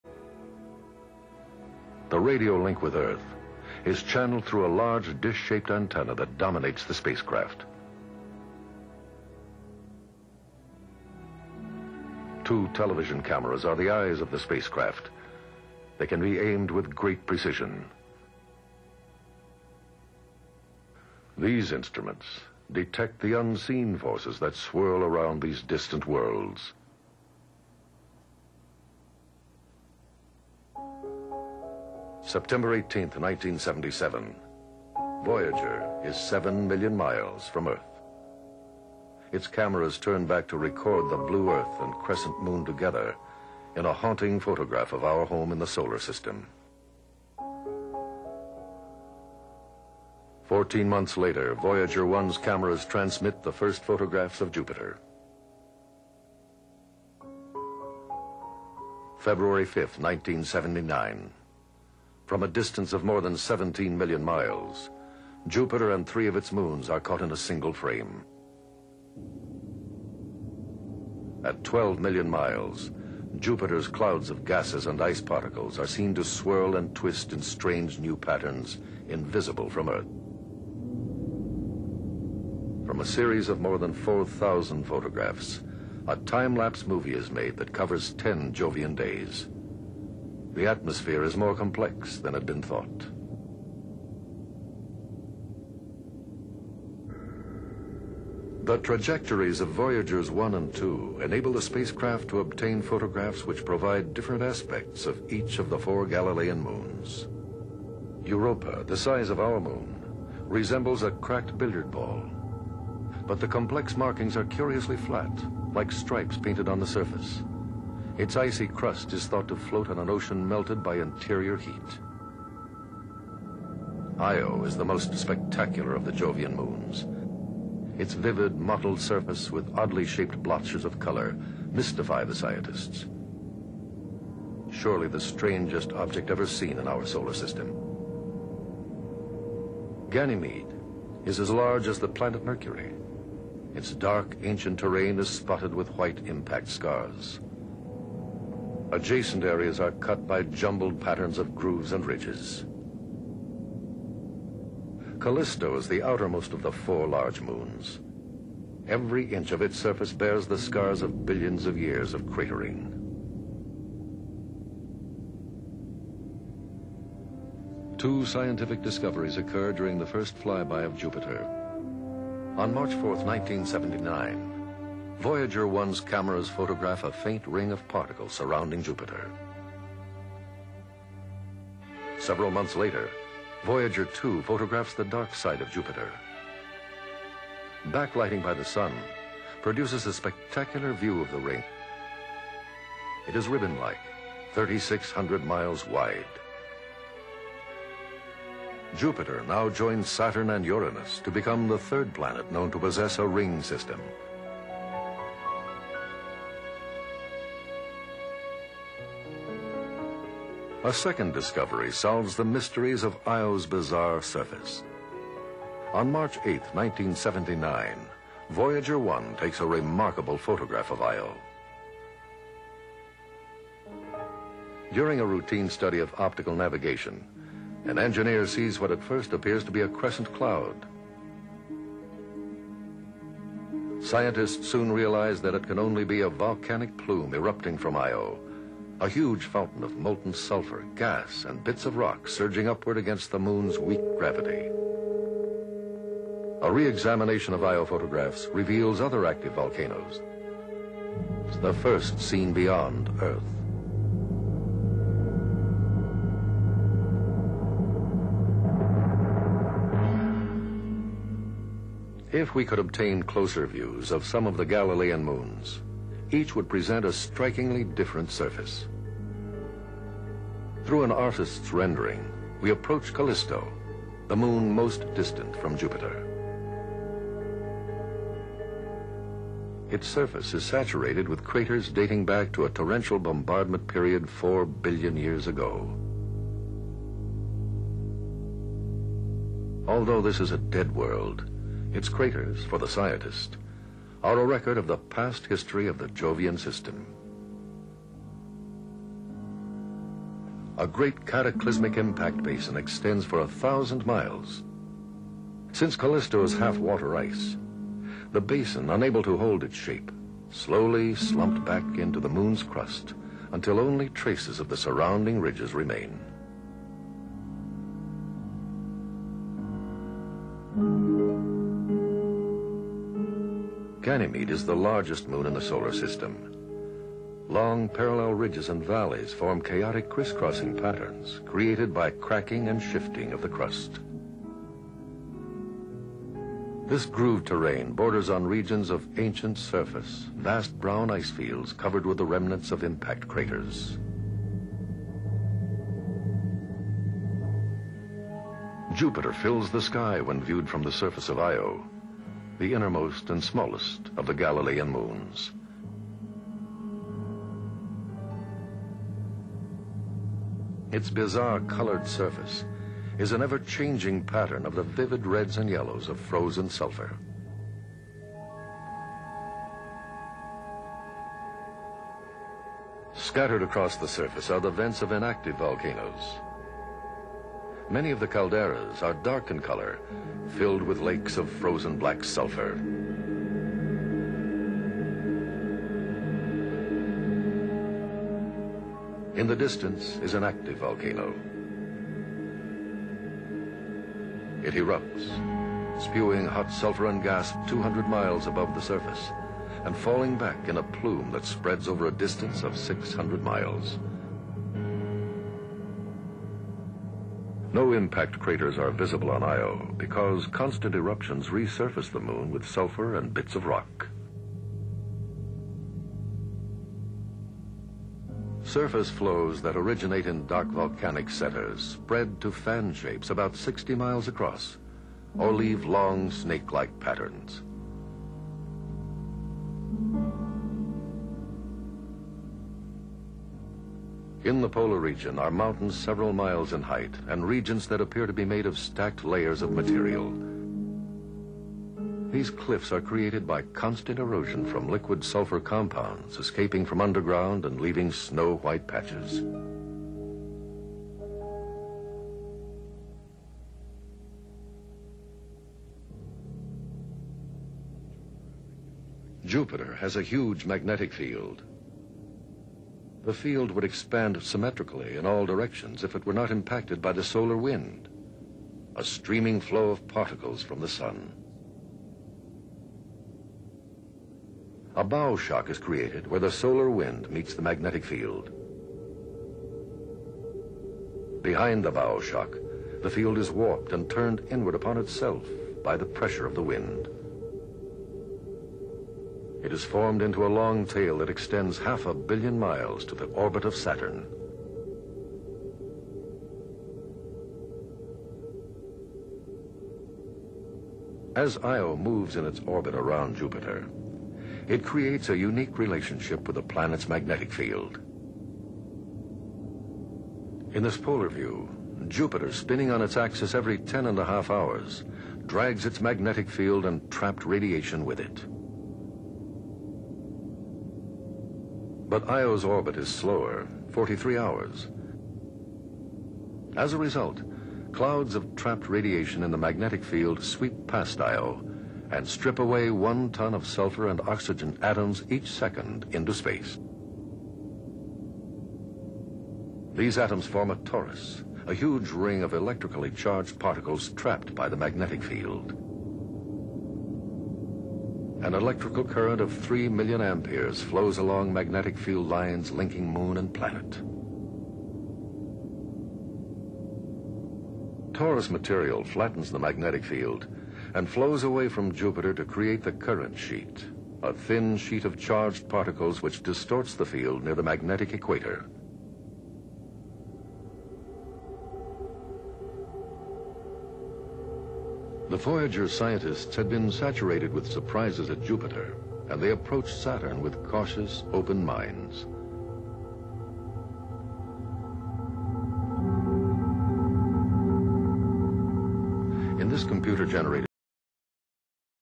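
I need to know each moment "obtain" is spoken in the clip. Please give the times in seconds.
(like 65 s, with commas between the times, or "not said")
102 s, 262 s.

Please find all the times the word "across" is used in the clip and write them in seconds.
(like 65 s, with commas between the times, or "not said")
373 s, 424 s.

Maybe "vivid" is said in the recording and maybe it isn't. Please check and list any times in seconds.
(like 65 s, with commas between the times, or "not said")
128 s, 364 s.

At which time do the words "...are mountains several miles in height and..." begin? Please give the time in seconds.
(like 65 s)
435 s.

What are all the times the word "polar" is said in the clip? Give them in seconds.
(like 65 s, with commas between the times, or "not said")
434 s, 510 s.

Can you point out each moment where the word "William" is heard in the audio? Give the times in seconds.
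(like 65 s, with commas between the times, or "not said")
not said.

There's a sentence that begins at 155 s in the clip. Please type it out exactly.
Callisto is the outermost of the four large moons.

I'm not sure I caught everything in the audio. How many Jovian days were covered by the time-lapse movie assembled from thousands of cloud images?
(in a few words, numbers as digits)
10.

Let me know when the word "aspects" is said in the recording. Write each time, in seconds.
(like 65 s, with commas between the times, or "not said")
104 s.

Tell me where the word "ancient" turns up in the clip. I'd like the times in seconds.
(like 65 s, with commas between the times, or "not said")
144 s, 339 s.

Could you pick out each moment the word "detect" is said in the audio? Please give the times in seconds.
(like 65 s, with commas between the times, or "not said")
22 s.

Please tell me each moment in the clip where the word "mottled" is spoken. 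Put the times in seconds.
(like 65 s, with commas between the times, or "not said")
128 s.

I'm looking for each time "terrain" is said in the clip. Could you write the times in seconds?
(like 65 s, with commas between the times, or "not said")
144 s, 337 s.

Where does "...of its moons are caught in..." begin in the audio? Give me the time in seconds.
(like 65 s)
66 s.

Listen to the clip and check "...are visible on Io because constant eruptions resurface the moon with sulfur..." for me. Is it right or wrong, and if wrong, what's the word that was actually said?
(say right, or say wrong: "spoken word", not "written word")
right.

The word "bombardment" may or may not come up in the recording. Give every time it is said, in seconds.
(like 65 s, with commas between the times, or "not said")
283 s.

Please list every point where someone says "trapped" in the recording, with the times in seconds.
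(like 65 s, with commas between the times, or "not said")
517 s, 528 s, 544 s.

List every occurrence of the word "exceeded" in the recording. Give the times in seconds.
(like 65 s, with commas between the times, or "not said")
not said.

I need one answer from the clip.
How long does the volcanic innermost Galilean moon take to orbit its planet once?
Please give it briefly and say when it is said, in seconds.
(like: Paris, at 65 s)
43 hours, at 523 s.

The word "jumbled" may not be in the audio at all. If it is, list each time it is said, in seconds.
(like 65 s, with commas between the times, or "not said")
150 s.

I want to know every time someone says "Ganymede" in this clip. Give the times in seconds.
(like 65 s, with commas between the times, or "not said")
140 s, 324 s.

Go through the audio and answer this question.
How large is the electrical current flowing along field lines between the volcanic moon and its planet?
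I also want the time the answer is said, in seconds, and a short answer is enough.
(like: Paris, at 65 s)
3 million amperes, at 549 s.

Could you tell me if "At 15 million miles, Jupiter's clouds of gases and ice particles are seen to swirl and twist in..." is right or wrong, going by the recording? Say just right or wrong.
wrong.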